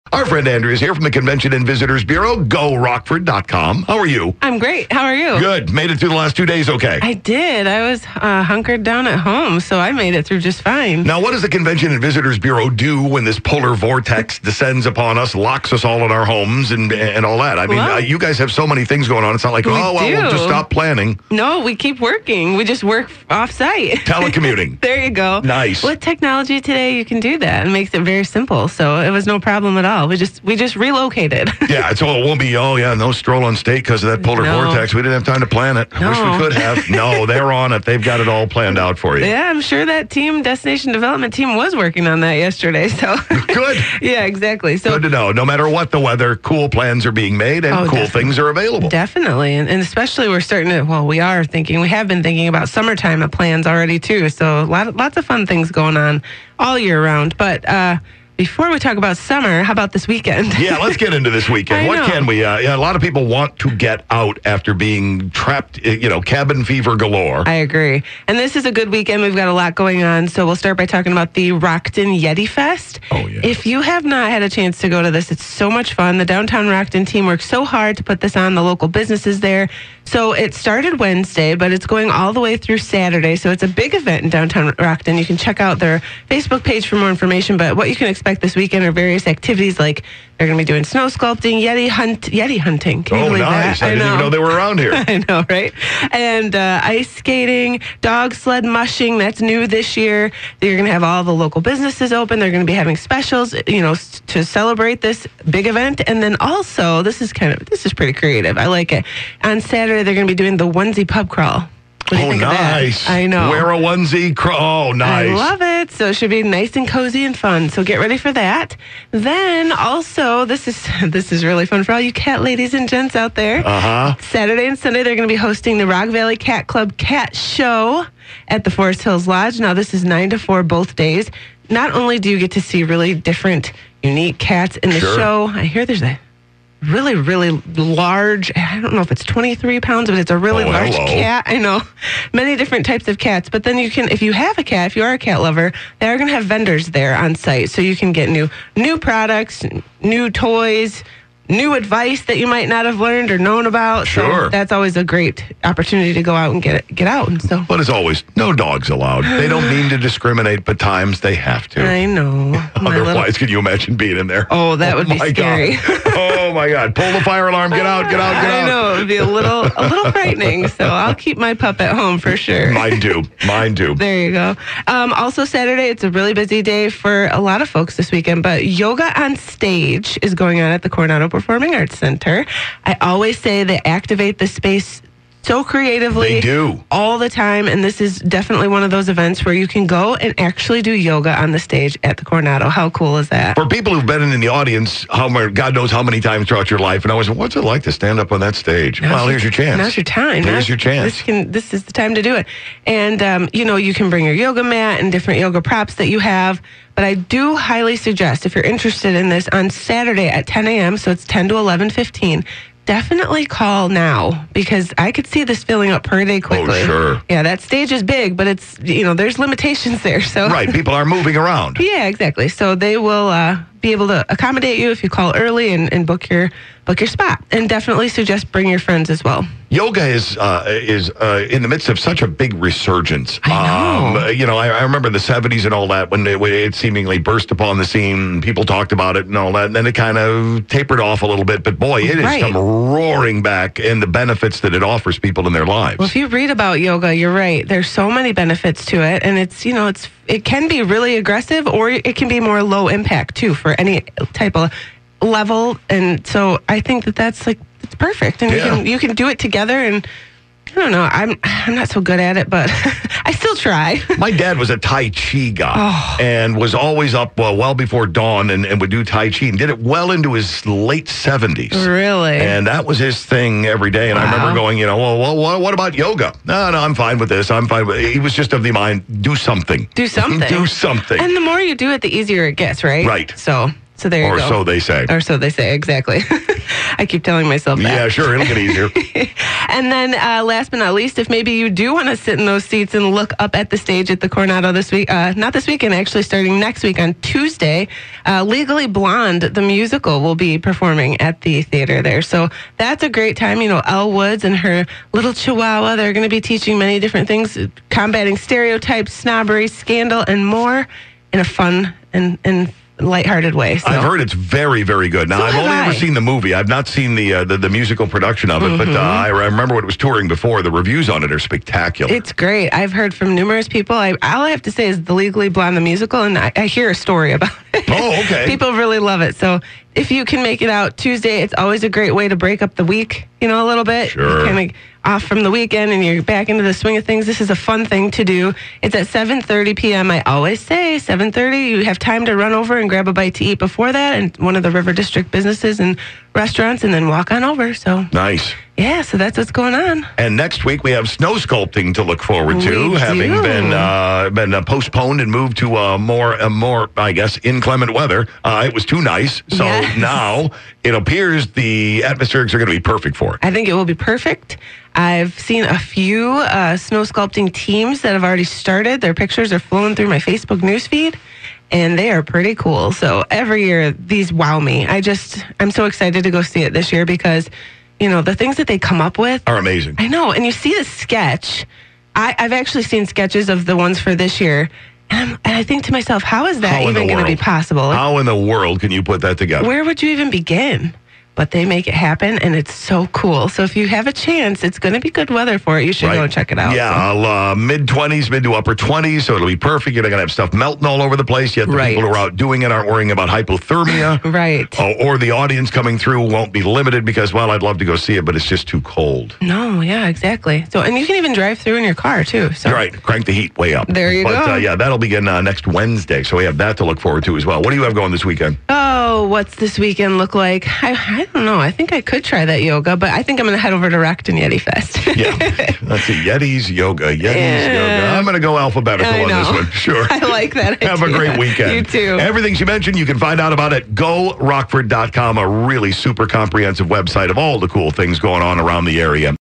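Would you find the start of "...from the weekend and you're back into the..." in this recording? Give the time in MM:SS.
05:35.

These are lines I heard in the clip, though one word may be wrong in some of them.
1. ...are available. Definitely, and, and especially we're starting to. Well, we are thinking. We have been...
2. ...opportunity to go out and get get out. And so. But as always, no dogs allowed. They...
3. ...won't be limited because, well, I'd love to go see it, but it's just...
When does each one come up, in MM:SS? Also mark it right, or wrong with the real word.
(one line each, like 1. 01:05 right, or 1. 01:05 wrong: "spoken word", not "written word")
1. 00:48 right
2. 02:35 right
3. 06:46 right.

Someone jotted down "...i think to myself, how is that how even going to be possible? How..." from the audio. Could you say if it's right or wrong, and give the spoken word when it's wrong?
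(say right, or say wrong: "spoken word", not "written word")
right.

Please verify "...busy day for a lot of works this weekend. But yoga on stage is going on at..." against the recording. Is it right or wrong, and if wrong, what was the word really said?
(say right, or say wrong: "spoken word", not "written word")
wrong: "folks", not "works".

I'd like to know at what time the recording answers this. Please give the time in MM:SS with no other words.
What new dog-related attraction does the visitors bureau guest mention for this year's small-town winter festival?
01:37.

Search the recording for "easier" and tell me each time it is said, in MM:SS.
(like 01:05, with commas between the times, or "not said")
04:42, 04:48.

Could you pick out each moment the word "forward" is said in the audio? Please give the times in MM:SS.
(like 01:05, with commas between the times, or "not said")
05:52, 06:56.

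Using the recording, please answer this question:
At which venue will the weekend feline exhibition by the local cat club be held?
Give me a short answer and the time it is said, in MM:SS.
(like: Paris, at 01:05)
Forest Hills Lodge, at 02:08.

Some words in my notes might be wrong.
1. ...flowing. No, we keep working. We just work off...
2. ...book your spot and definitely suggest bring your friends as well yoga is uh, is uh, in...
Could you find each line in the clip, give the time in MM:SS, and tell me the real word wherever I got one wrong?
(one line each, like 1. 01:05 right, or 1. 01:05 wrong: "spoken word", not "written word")
1. 00:20 wrong: "planning", not "flowing"
2. 03:46 right.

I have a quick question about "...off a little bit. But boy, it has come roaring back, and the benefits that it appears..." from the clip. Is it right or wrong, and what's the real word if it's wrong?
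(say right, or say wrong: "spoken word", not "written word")
wrong: "offers", not "appears".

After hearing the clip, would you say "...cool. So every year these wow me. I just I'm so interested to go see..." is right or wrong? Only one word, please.
wrong.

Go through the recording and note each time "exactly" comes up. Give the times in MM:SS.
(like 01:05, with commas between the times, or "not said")
00:44, 03:42, 04:45, 06:50.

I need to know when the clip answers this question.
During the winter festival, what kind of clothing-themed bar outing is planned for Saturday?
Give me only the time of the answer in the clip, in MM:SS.
01:50.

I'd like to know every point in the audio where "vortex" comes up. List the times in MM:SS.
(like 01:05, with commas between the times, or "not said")
00:13, 00:34.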